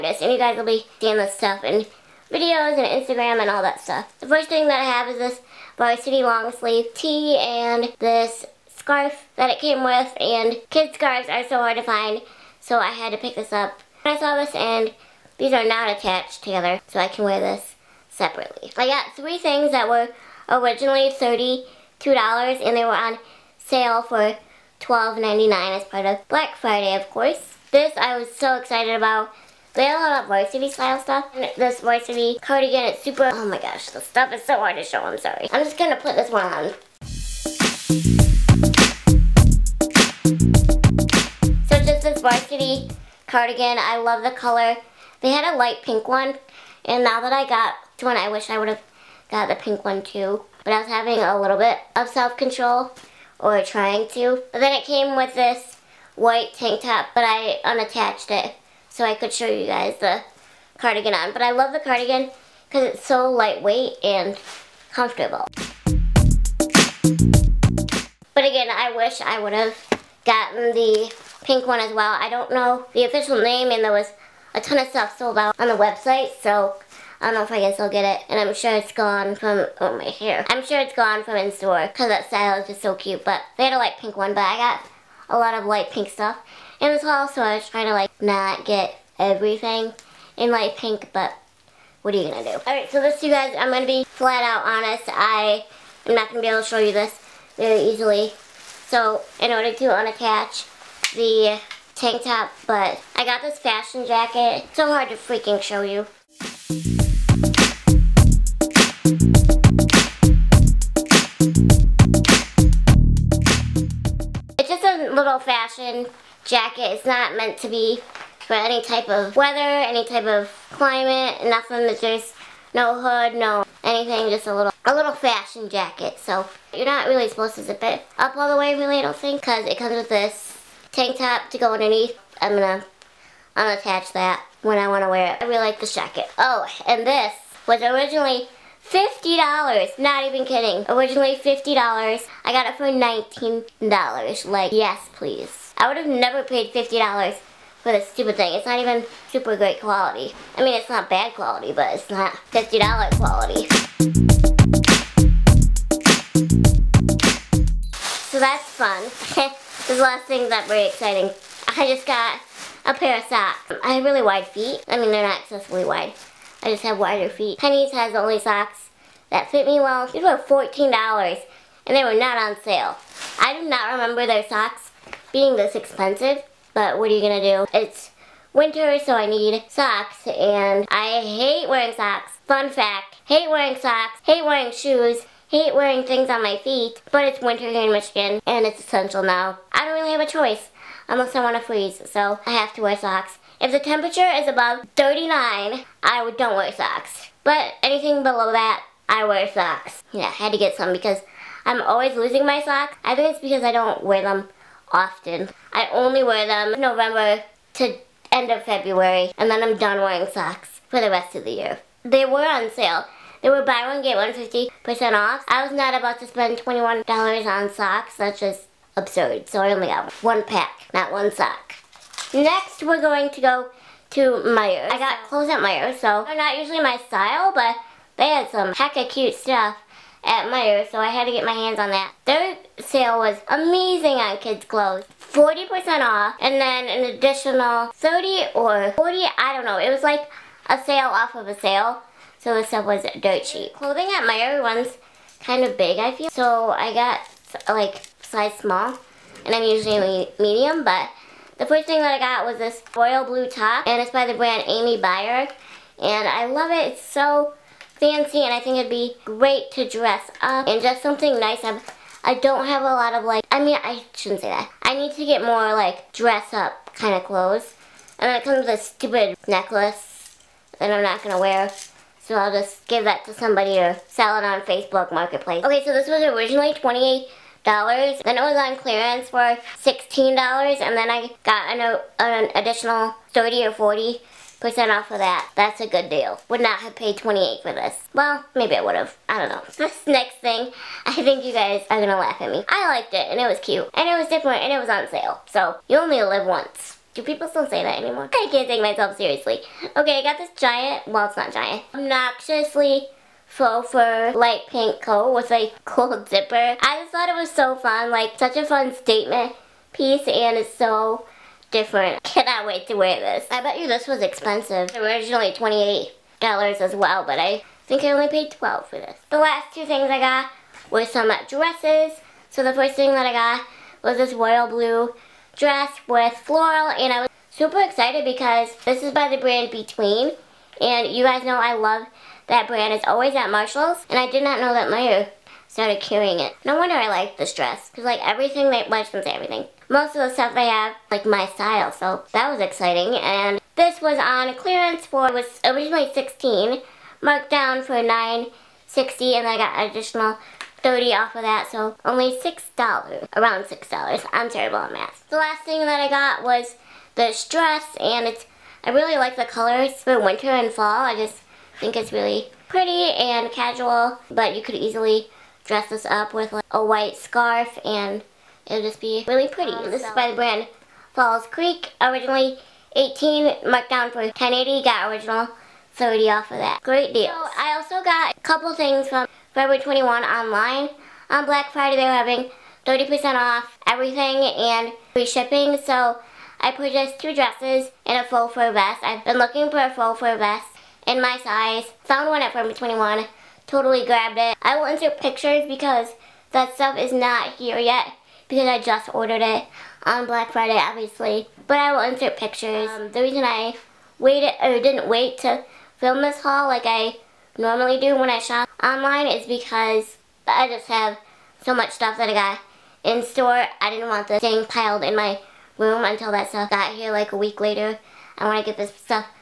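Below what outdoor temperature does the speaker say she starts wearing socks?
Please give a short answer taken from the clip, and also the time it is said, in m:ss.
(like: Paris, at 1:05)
39, at 3:14.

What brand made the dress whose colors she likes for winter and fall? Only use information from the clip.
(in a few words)
Falls Creek.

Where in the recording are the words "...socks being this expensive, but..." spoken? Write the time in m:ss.
2:54.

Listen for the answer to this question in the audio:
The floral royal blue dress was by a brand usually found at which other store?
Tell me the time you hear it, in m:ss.
5:33.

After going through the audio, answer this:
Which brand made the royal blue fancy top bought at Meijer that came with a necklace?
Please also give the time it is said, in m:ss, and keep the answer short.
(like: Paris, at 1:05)
Amy Byer, at 4:14.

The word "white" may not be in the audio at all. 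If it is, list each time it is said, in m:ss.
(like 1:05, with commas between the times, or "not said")
0:56, 6:06.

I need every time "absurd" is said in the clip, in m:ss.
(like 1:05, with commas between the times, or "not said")
3:38.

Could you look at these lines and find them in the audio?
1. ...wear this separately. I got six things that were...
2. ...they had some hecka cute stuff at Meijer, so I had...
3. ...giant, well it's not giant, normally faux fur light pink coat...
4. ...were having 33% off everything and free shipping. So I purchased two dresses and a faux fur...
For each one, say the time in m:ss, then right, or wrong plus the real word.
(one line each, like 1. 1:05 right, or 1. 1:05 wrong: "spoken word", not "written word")
1. 0:17 wrong: "three", not "six"
2. 3:48 right
3. 5:00 wrong: "obnoxiously", not "normally"
4. 6:22 wrong: "30", not "33".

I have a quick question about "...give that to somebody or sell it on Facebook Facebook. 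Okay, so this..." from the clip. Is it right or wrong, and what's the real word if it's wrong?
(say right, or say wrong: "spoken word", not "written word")
wrong: "Marketplace", not "Facebook".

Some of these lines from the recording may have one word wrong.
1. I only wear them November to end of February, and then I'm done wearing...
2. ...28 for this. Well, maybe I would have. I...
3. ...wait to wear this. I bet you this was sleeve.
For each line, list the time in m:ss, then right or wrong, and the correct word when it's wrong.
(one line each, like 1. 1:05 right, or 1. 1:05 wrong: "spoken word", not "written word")
1. 3:25 right
2. 4:47 right
3. 5:12 wrong: "expensive", not "sleeve".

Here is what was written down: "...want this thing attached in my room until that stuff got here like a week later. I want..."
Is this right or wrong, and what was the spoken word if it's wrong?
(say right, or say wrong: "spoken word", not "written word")
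wrong: "piled", not "attached".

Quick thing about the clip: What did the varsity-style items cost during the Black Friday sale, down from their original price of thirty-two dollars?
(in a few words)
$12.99.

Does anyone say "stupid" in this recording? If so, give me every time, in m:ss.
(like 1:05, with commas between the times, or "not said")
2:28, 4:28.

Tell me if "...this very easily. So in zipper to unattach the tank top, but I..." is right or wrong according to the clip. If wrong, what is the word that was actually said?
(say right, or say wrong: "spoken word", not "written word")
wrong: "order", not "zipper".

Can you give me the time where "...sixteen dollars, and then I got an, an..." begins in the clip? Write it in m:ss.
4:39.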